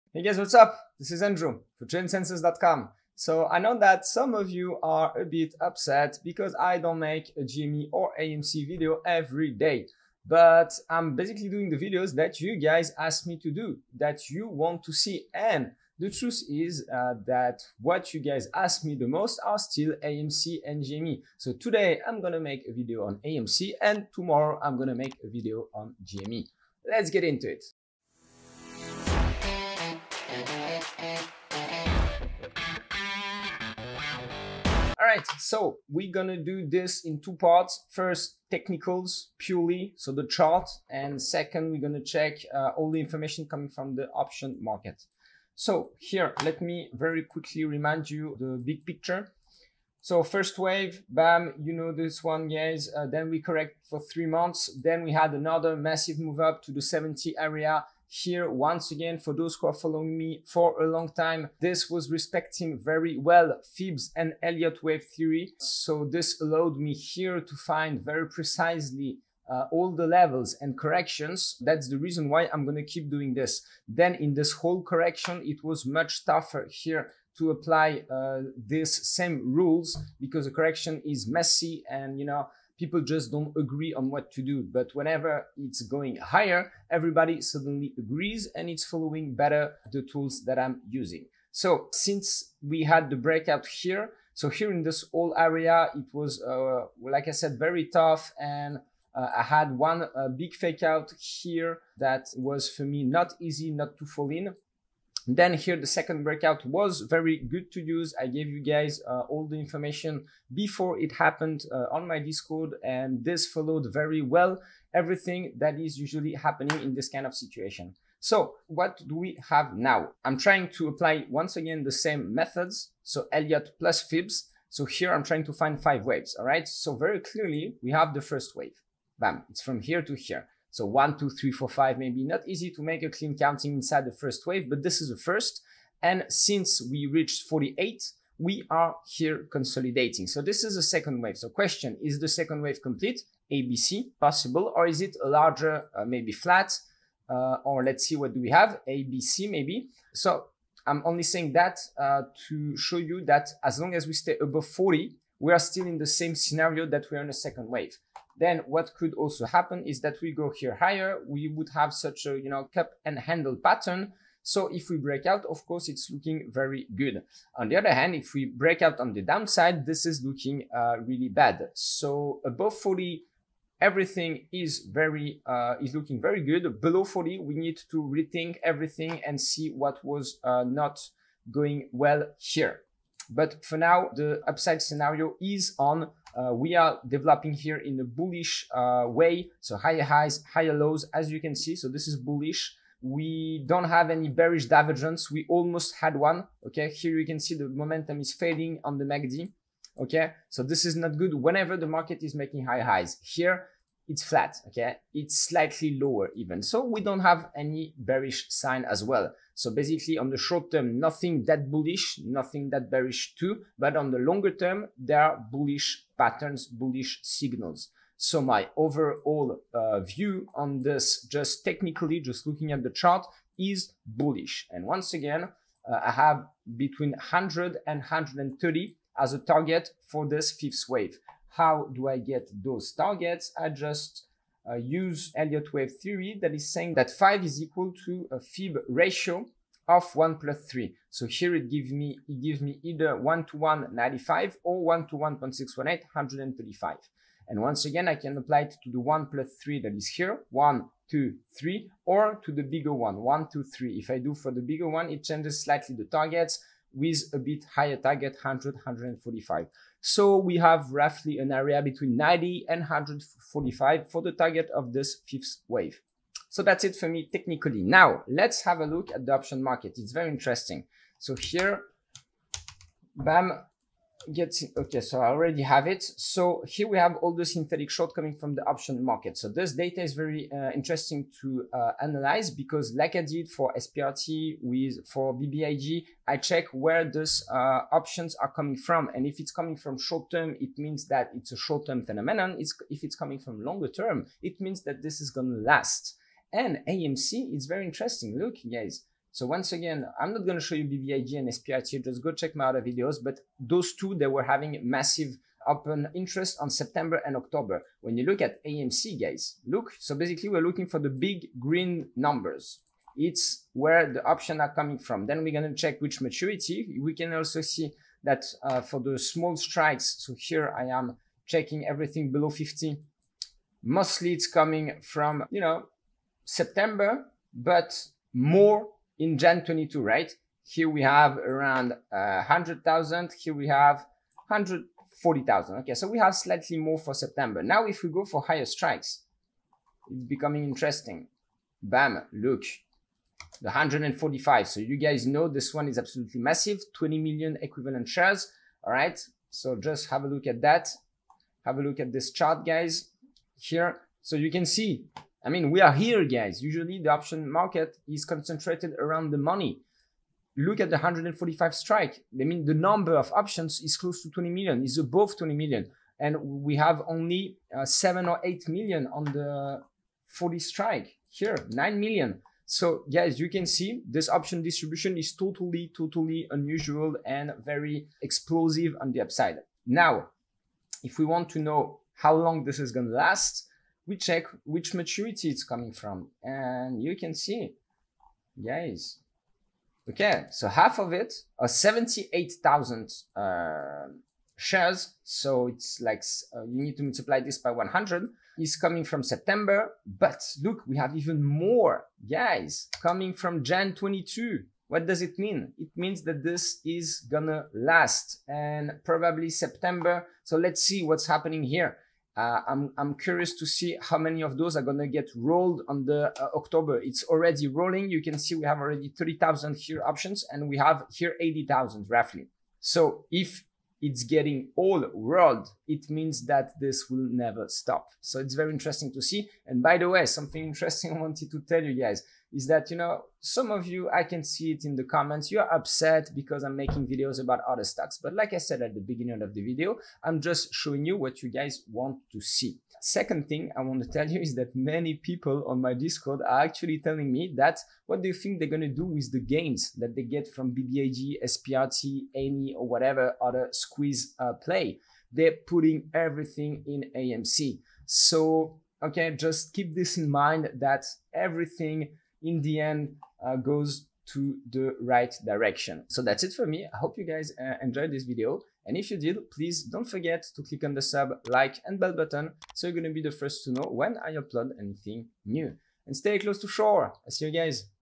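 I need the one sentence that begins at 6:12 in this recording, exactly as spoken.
So guys, you can see this option distribution is totally, totally unusual and very explosive on the upside.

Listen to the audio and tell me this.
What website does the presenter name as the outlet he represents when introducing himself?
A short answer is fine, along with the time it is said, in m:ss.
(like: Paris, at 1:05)
GymSenses.com, at 0:01.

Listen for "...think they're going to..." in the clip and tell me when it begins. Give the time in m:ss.
7:28.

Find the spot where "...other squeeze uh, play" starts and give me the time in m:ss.
7:33.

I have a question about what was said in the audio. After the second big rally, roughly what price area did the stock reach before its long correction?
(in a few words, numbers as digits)
70.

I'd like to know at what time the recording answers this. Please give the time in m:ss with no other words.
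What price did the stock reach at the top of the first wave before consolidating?
2:17.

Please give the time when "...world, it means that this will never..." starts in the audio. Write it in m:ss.
7:05.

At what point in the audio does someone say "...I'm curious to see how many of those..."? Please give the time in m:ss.
6:52.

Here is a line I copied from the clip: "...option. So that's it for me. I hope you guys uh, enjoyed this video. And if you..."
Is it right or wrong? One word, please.
wrong.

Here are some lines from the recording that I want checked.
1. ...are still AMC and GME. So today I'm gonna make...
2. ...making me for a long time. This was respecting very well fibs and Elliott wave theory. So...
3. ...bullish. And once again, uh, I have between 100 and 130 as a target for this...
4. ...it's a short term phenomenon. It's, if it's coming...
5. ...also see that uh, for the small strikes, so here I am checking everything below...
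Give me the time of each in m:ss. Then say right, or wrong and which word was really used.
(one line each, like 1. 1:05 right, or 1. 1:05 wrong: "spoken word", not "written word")
1. 0:19 right
2. 0:59 wrong: "following", not "making"
3. 3:44 right
4. 4:51 right
5. 5:17 right.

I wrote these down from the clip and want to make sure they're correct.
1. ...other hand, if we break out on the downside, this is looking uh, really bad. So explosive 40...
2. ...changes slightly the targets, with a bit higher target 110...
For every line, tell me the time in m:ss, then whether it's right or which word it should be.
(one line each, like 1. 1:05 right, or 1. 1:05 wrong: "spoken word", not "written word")
1. 2:47 wrong: "above", not "explosive"
2. 4:15 wrong: "100", not "110".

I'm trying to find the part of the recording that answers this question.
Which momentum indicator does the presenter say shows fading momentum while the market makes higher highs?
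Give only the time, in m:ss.
3:19.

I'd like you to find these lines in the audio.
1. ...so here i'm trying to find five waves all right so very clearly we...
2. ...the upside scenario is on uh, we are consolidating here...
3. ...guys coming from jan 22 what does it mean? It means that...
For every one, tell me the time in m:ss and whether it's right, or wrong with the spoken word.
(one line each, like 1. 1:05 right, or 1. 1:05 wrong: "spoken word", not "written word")
1. 2:04 right
2. 3:04 wrong: "developing", not "consolidating"
3. 6:42 right.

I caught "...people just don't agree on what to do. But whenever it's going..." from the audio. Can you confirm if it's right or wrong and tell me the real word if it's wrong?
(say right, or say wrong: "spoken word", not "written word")
right.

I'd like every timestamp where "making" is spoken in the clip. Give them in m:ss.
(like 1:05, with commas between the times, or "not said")
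3:22, 7:16.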